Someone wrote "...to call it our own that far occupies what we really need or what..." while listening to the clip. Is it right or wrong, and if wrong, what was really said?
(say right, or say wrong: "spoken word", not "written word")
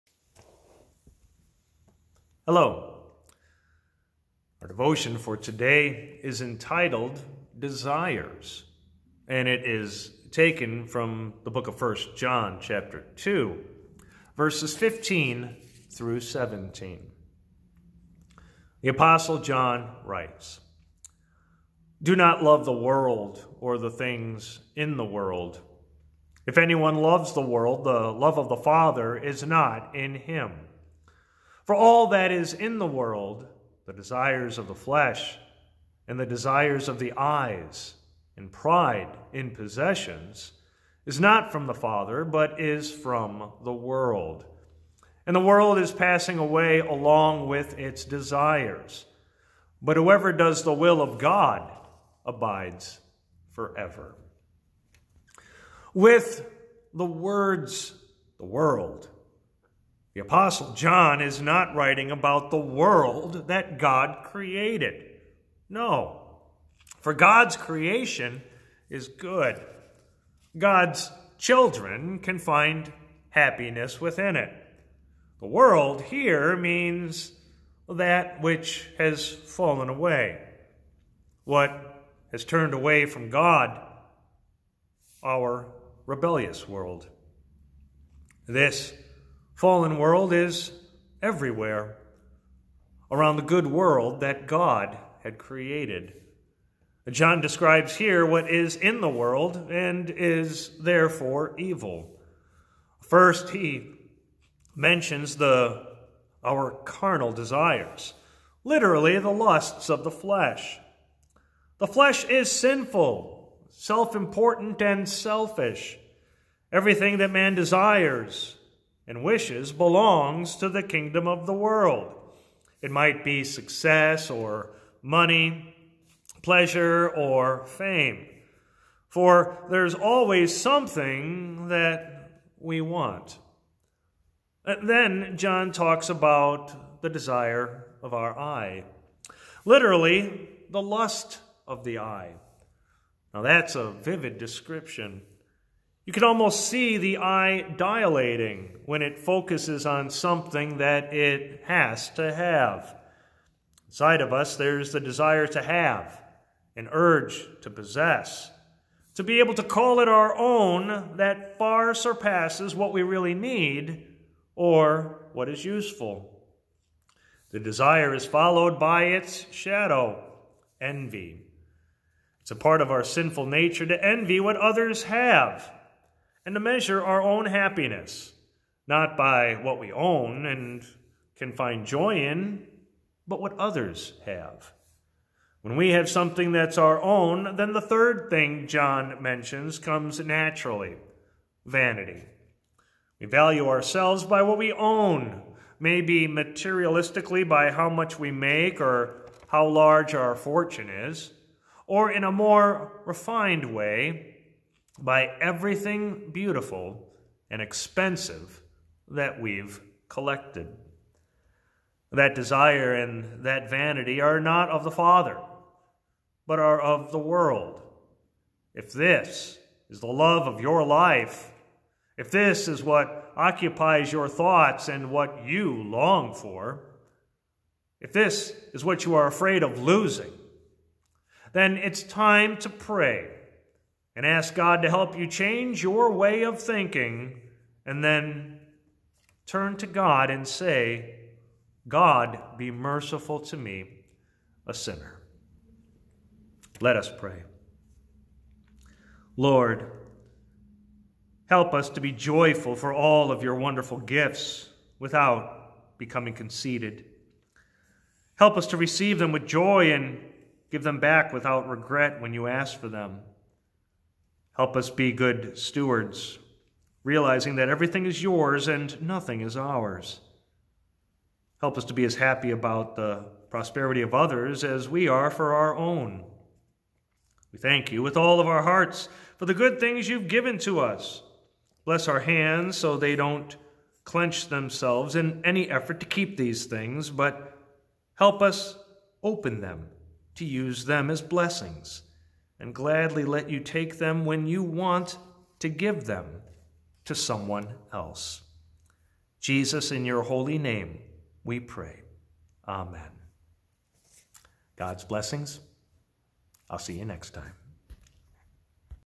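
wrong: "surpasses", not "occupies".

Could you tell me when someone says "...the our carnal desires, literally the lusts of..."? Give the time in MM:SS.
01:45.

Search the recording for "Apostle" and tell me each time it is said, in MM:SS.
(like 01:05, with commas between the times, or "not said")
00:18, 01:00.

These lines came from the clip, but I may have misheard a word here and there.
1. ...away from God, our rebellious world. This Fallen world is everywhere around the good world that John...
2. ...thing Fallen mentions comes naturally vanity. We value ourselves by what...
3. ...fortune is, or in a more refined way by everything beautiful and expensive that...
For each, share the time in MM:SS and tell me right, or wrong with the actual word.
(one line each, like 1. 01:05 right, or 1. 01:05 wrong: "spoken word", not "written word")
1. 01:22 wrong: "God", not "John"
2. 03:08 wrong: "John", not "Fallen"
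3. 03:20 right.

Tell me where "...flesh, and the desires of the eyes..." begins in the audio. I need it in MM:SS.
00:34.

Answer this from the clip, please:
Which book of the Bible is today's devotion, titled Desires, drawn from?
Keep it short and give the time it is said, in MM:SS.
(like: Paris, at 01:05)
First John, at 00:11.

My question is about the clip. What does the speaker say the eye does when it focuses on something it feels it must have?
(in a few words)
dilating.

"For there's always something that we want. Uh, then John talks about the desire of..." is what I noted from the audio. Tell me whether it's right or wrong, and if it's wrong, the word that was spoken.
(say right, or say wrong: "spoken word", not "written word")
right.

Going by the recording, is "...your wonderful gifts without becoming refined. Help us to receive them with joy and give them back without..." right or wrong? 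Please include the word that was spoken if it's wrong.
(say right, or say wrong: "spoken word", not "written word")
wrong: "conceited", not "refined".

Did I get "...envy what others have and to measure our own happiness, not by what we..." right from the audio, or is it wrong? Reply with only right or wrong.
right.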